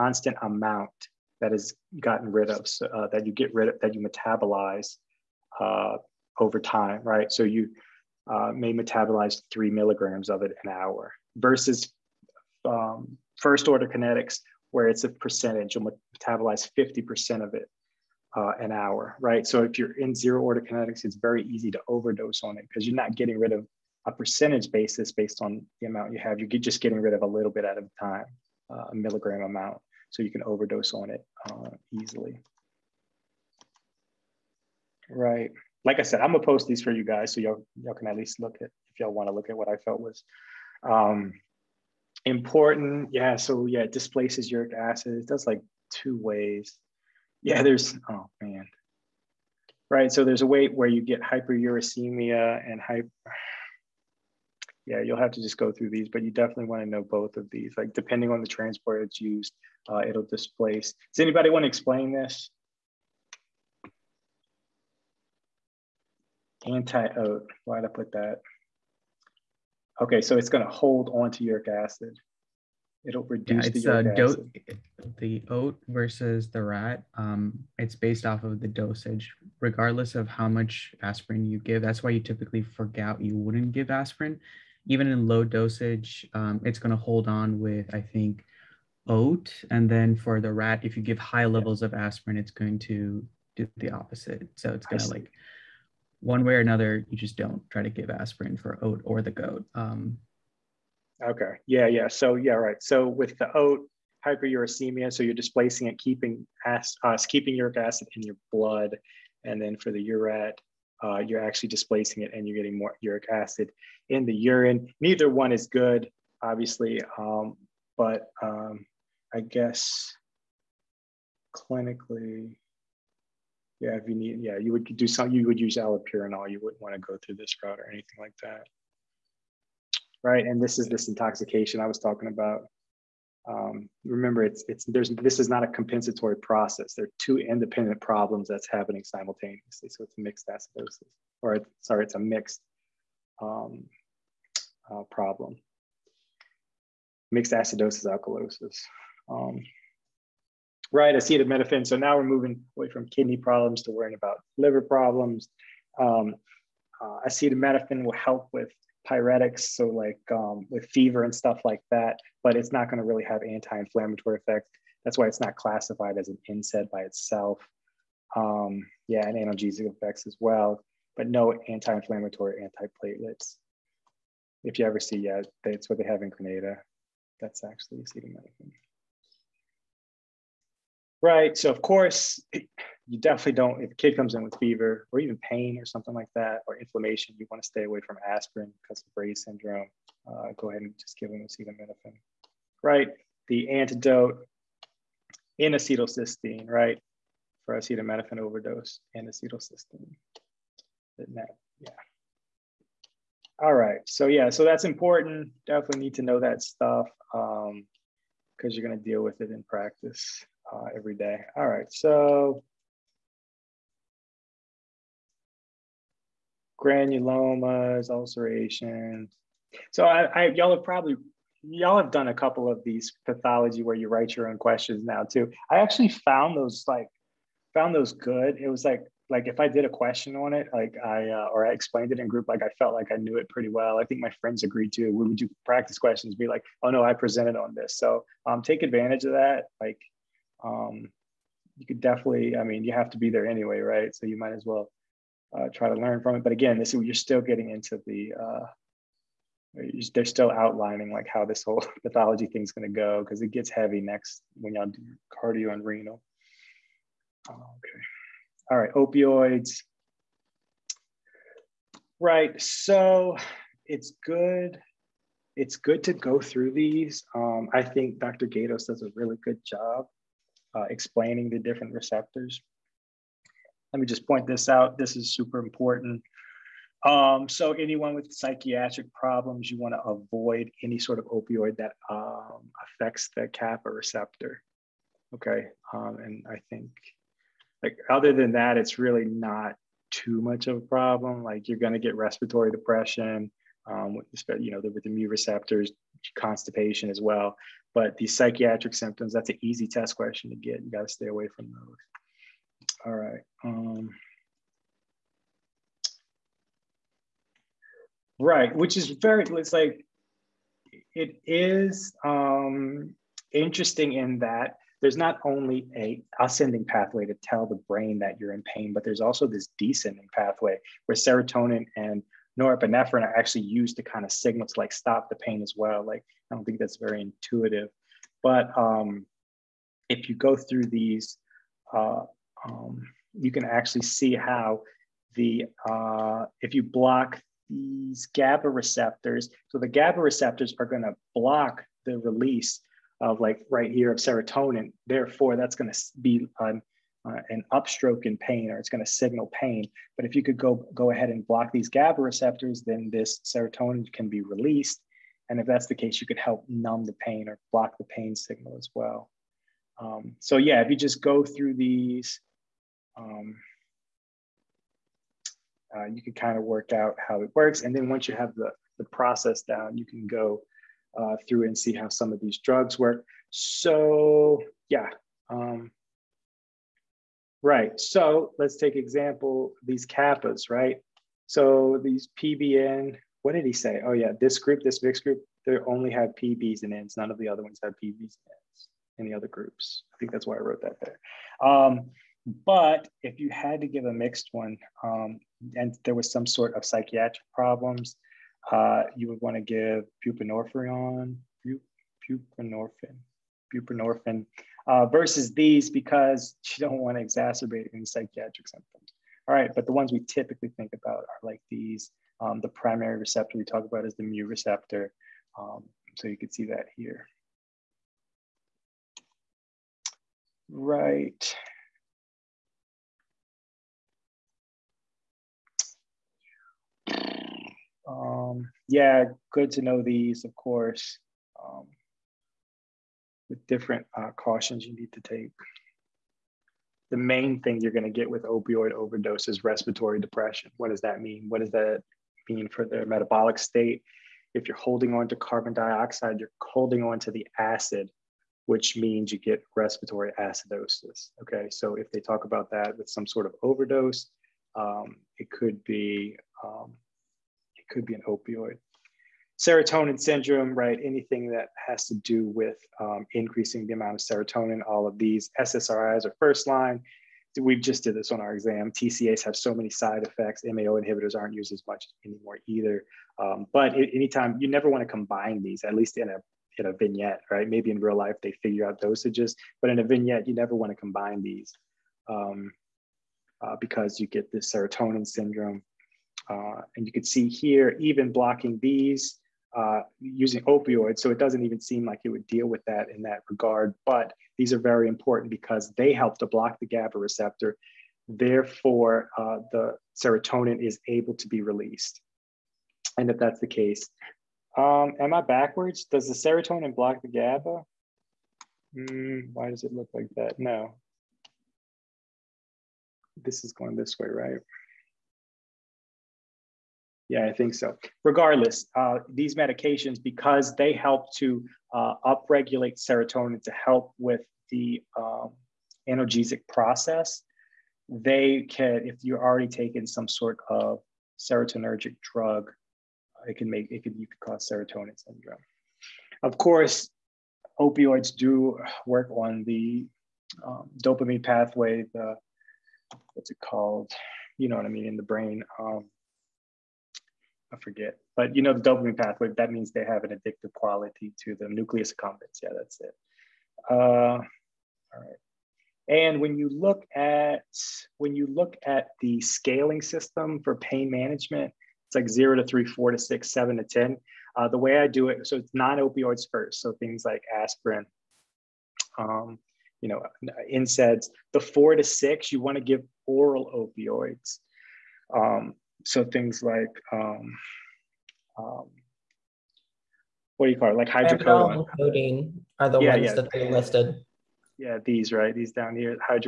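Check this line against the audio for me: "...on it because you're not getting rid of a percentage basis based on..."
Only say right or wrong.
right.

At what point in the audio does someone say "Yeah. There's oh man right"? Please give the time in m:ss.
0:47.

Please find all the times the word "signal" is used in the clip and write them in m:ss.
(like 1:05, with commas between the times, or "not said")
5:24, 5:49, 5:58.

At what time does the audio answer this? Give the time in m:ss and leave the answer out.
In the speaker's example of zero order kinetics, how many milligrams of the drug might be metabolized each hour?
0:09.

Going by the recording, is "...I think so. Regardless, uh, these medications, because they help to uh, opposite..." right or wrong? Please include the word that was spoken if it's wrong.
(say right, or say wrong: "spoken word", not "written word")
wrong: "upregulate", not "opposite".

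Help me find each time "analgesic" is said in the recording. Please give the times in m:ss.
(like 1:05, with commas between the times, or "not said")
2:49, 8:46.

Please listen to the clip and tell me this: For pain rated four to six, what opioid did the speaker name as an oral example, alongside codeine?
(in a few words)
hydrocodone.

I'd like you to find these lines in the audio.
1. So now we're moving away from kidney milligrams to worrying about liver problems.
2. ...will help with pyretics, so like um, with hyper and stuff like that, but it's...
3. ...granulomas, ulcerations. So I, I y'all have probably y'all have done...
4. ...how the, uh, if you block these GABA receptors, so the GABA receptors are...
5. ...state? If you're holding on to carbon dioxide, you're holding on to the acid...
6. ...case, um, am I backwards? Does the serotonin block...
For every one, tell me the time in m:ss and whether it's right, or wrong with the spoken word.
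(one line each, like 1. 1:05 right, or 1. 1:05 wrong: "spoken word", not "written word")
1. 2:31 wrong: "problems", not "milligrams"
2. 2:38 wrong: "fever", not "hyper"
3. 3:36 right
4. 5:34 right
5. 7:23 right
6. 8:23 right.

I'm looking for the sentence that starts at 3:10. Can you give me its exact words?
Uh, go ahead and just give them acetaminophen.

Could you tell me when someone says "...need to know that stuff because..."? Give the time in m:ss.
3:26.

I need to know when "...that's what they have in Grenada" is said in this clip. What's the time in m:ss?
2:55.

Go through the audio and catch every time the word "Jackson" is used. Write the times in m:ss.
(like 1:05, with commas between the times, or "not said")
not said.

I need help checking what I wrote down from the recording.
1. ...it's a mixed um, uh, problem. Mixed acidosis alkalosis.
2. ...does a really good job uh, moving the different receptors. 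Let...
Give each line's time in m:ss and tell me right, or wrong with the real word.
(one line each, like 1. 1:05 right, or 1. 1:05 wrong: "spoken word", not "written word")
1. 2:22 right
2. 4:28 wrong: "explaining", not "moving".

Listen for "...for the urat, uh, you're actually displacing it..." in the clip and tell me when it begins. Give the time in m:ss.
1:49.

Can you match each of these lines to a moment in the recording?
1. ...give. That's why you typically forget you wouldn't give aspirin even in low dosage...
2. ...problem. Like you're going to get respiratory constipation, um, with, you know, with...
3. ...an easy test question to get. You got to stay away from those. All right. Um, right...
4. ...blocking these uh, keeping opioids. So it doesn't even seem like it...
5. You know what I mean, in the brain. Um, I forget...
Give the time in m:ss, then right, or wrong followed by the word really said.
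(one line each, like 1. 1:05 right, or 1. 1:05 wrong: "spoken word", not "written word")
1. 1:21 right
2. 4:50 wrong: "depression", not "constipation"
3. 4:59 right
4. 8:08 wrong: "using", not "keeping"
5. 9:04 right.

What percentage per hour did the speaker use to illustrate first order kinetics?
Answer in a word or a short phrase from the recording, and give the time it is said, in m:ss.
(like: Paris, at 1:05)
50%, at 0:16.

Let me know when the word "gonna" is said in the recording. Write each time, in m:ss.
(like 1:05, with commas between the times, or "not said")
0:36.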